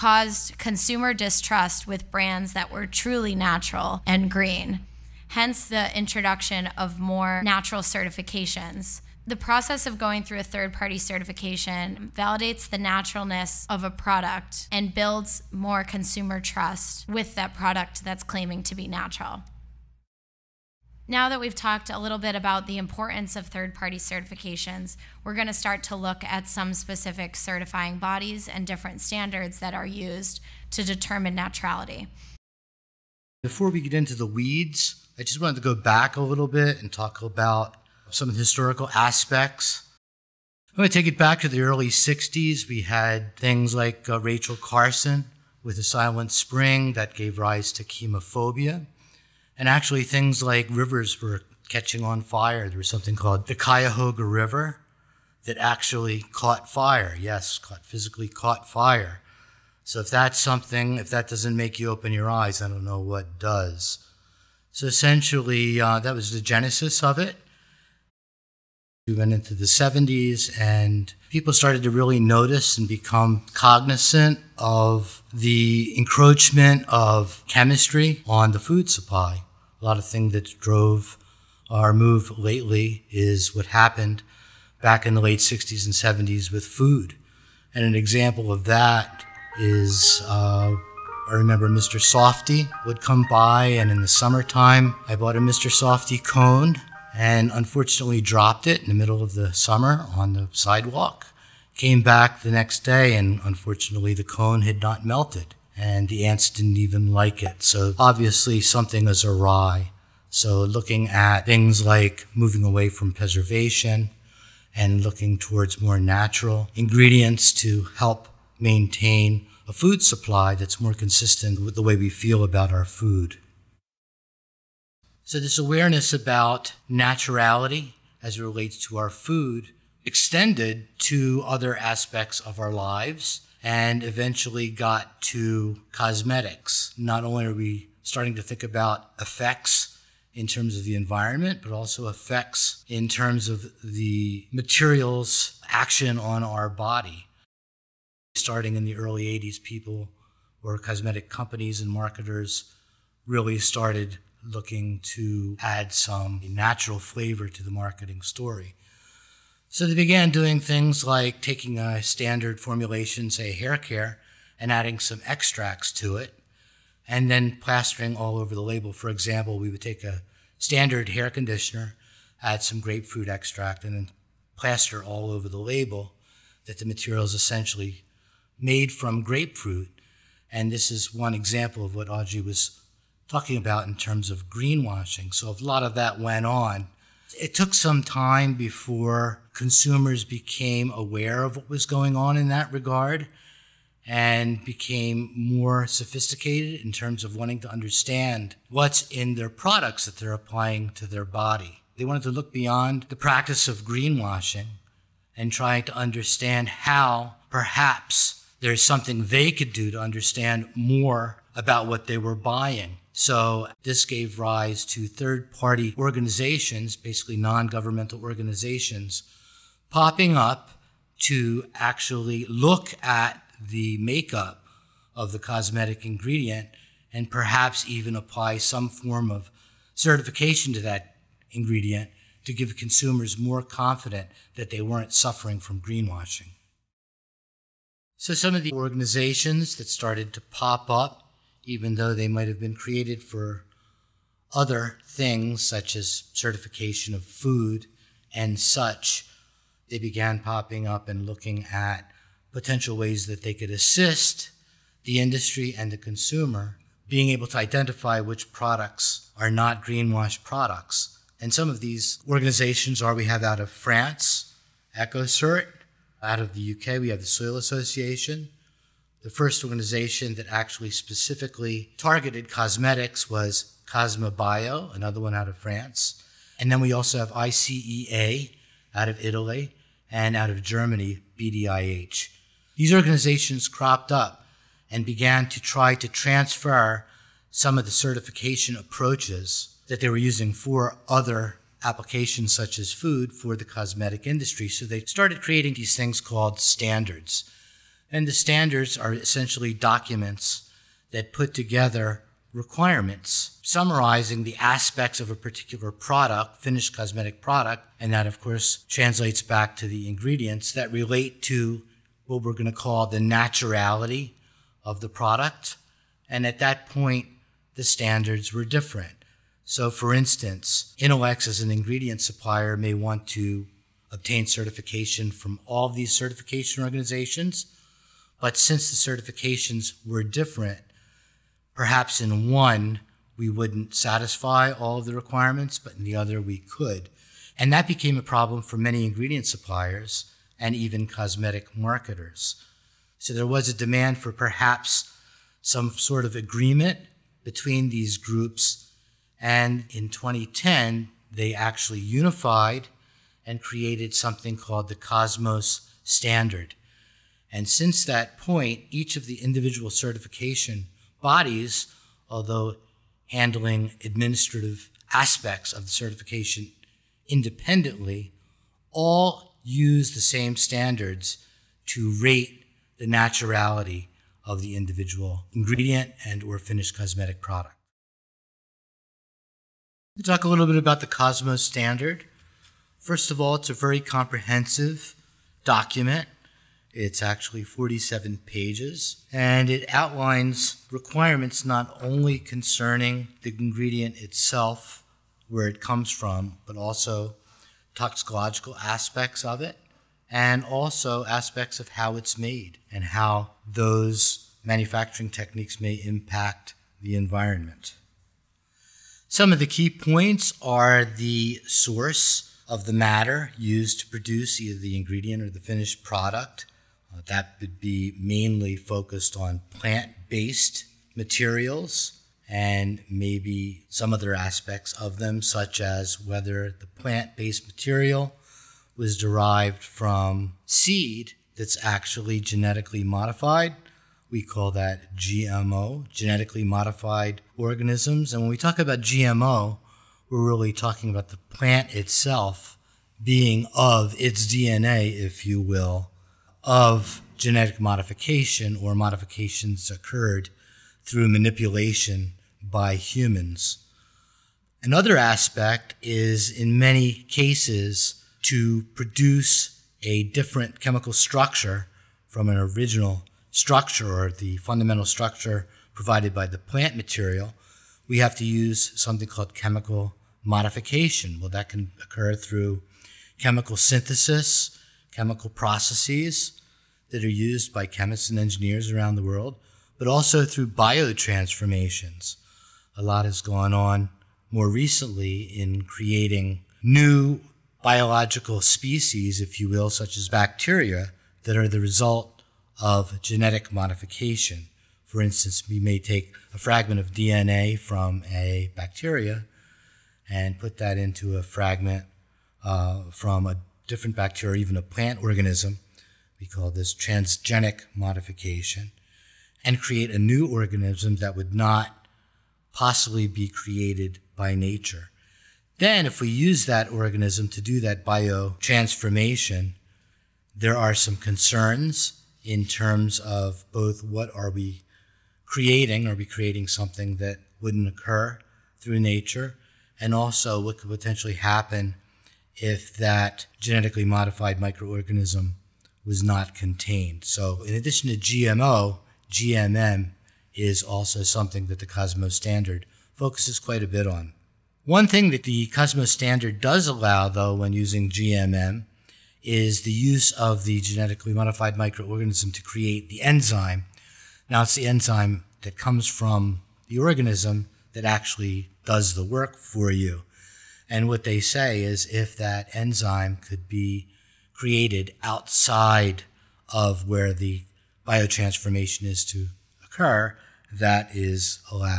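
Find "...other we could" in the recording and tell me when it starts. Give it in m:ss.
5:36.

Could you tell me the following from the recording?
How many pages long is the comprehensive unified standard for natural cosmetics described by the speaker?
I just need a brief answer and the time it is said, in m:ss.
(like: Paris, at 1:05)
47, at 6:27.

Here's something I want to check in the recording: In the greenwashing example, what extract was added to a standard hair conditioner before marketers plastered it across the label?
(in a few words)
grapefruit extract.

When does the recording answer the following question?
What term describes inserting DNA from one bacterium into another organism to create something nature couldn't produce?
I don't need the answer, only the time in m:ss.
8:26.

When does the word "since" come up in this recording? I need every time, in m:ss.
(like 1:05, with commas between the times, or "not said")
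5:28, 5:57.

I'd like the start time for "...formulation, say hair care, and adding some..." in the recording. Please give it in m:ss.
2:42.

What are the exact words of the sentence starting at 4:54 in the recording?
So they started creating these things called standards.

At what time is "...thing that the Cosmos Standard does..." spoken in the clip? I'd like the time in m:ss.
9:05.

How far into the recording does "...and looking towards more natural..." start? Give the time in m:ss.
1:54.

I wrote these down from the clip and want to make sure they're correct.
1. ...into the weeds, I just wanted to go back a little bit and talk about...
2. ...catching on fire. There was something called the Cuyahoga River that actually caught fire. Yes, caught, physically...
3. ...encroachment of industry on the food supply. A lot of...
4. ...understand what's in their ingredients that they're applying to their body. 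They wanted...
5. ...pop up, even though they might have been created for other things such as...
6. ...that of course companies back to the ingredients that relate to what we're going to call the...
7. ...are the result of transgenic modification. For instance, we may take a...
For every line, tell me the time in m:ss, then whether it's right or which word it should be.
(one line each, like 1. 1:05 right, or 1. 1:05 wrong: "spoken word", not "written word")
1. 0:33 right
2. 0:51 right
3. 1:15 wrong: "chemistry", not "industry"
4. 3:17 wrong: "products", not "ingredients"
5. 4:00 right
6. 5:08 wrong: "translates", not "companies"
7. 8:11 wrong: "genetic", not "transgenic".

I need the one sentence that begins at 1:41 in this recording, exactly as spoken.
Came back the next day, and unfortunately, the cone had not melted, and the ants didn't even like it.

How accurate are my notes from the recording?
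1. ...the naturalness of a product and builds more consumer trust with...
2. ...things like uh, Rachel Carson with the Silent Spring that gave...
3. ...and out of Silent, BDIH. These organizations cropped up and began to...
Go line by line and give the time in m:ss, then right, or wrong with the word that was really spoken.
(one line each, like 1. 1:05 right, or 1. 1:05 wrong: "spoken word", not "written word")
1. 0:12 right
2. 0:43 right
3. 4:40 wrong: "Germany", not "Silent".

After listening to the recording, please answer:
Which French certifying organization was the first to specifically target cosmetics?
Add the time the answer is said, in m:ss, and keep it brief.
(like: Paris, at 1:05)
Cosmebio, at 4:33.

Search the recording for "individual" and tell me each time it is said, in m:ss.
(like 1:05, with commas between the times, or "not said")
5:59, 6:14.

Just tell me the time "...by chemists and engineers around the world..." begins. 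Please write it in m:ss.
7:57.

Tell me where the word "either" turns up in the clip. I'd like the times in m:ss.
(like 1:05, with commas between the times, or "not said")
6:54.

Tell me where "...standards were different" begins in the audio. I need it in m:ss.
5:17.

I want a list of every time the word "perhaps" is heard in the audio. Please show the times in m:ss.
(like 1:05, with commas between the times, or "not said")
3:27, 3:47, 5:31, 5:44.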